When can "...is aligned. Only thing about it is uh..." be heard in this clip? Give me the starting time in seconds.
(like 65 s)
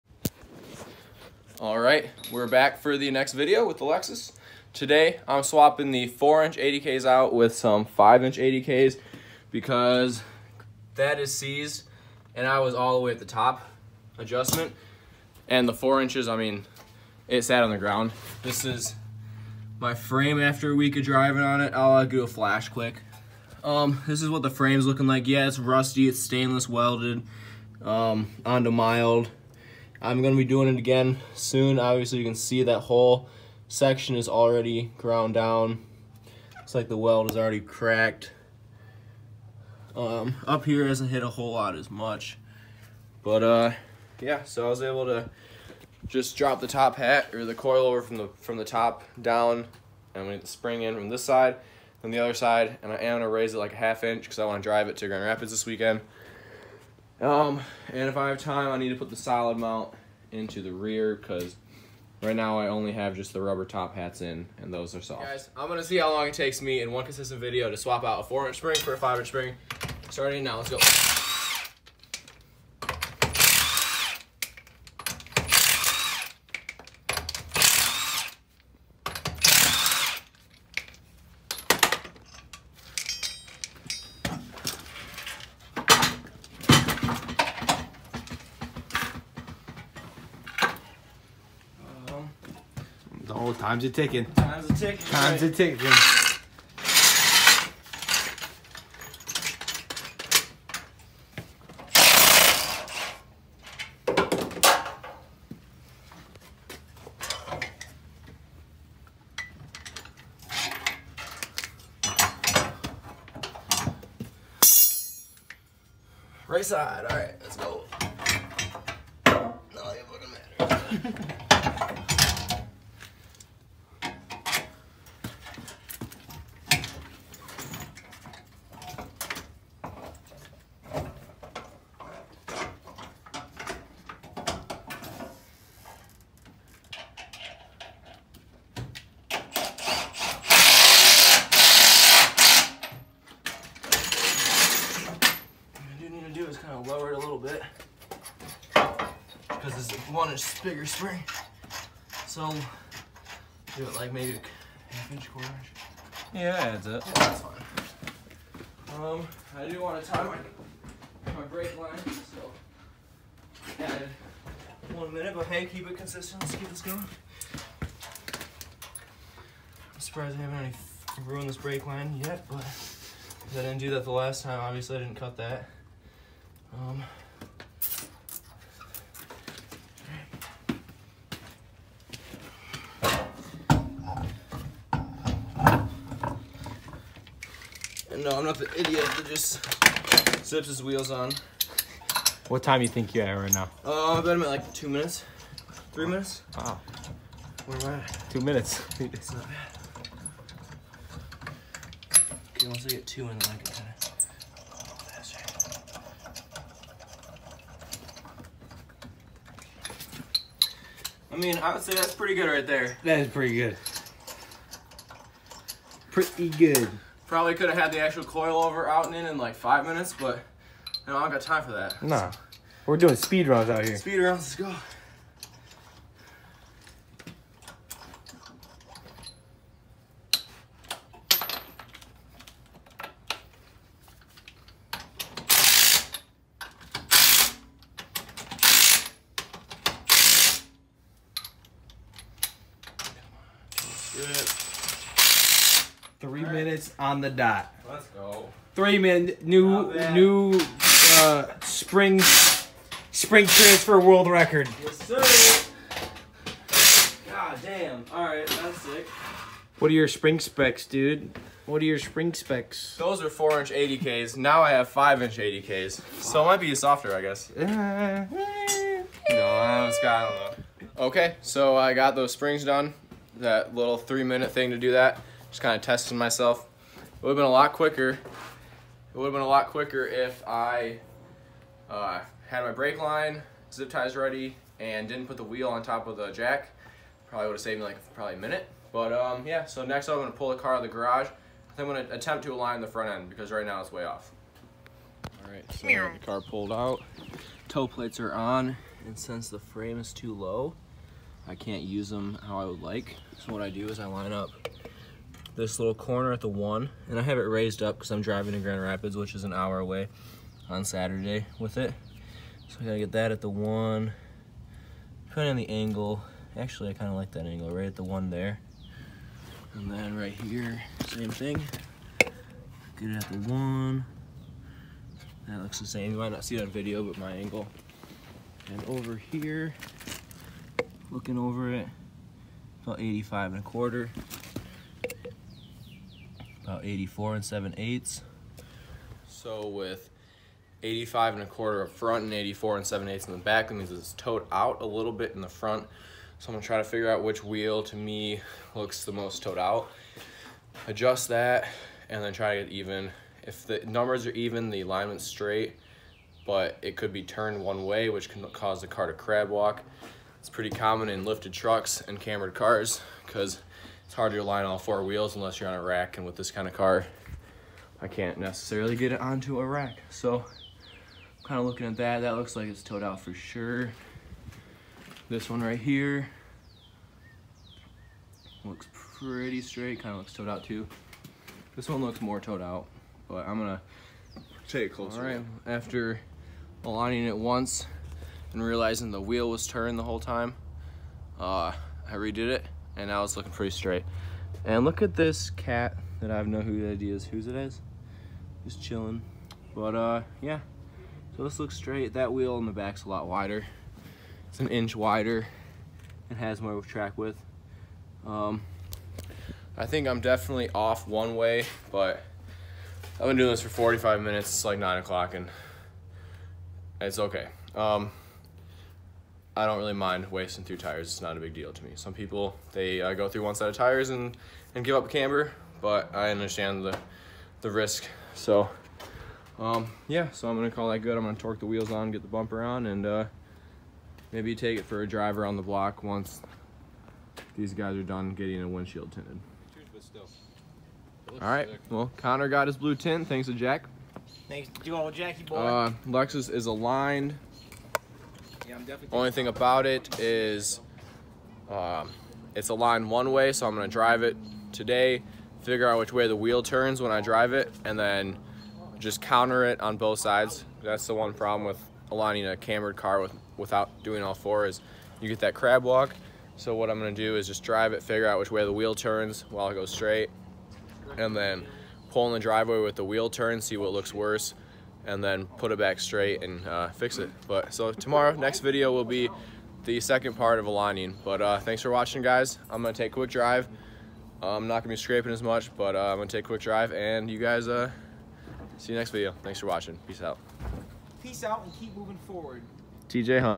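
446 s.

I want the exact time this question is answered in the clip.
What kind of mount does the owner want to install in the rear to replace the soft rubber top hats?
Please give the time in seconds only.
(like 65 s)
59 s.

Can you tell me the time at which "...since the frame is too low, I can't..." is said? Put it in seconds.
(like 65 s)
299 s.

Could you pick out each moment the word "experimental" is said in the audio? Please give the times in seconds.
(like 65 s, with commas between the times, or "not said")
not said.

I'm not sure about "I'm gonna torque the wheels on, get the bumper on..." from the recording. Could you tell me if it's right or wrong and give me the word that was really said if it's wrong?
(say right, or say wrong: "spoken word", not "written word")
right.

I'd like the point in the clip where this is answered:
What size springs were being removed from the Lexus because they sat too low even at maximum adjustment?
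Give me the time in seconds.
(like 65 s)
6 s.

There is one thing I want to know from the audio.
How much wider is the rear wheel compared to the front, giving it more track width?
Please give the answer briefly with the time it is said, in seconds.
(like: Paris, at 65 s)
1 inch, at 404 s.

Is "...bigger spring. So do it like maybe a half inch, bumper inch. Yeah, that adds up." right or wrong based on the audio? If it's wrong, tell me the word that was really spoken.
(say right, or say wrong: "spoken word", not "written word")
wrong: "quarter", not "bumper".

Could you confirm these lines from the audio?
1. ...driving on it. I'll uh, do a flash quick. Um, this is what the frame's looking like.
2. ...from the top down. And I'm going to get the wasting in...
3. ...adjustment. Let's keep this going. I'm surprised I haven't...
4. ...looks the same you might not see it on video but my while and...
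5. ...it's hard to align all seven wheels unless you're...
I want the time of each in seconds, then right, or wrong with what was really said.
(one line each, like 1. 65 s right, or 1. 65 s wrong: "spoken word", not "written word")
1. 21 s right
2. 48 s wrong: "spring", not "wasting"
3. 165 s wrong: "consistent", not "adjustment"
4. 325 s wrong: "angle", not "while"
5. 364 s wrong: "four", not "seven".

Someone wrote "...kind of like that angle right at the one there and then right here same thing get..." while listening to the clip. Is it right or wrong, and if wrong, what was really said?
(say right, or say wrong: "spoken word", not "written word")
right.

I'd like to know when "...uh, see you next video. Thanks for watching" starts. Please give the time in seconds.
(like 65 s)
487 s.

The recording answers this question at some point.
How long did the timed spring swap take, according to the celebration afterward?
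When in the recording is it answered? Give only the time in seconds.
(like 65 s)
248 s.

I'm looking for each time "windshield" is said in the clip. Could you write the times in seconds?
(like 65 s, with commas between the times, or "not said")
438 s.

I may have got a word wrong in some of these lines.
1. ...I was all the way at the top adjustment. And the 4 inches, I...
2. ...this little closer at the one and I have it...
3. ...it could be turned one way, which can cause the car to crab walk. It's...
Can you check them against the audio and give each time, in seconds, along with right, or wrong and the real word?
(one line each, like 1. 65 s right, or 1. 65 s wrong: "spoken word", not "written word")
1. 12 s right
2. 305 s wrong: "corner", not "closer"
3. 356 s right.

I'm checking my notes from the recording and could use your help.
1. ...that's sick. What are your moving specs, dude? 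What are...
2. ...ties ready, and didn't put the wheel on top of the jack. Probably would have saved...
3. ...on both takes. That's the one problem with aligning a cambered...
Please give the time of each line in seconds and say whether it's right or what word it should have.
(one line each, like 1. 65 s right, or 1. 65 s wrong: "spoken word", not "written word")
1. 258 s wrong: "spring", not "moving"
2. 283 s right
3. 459 s wrong: "sides", not "takes".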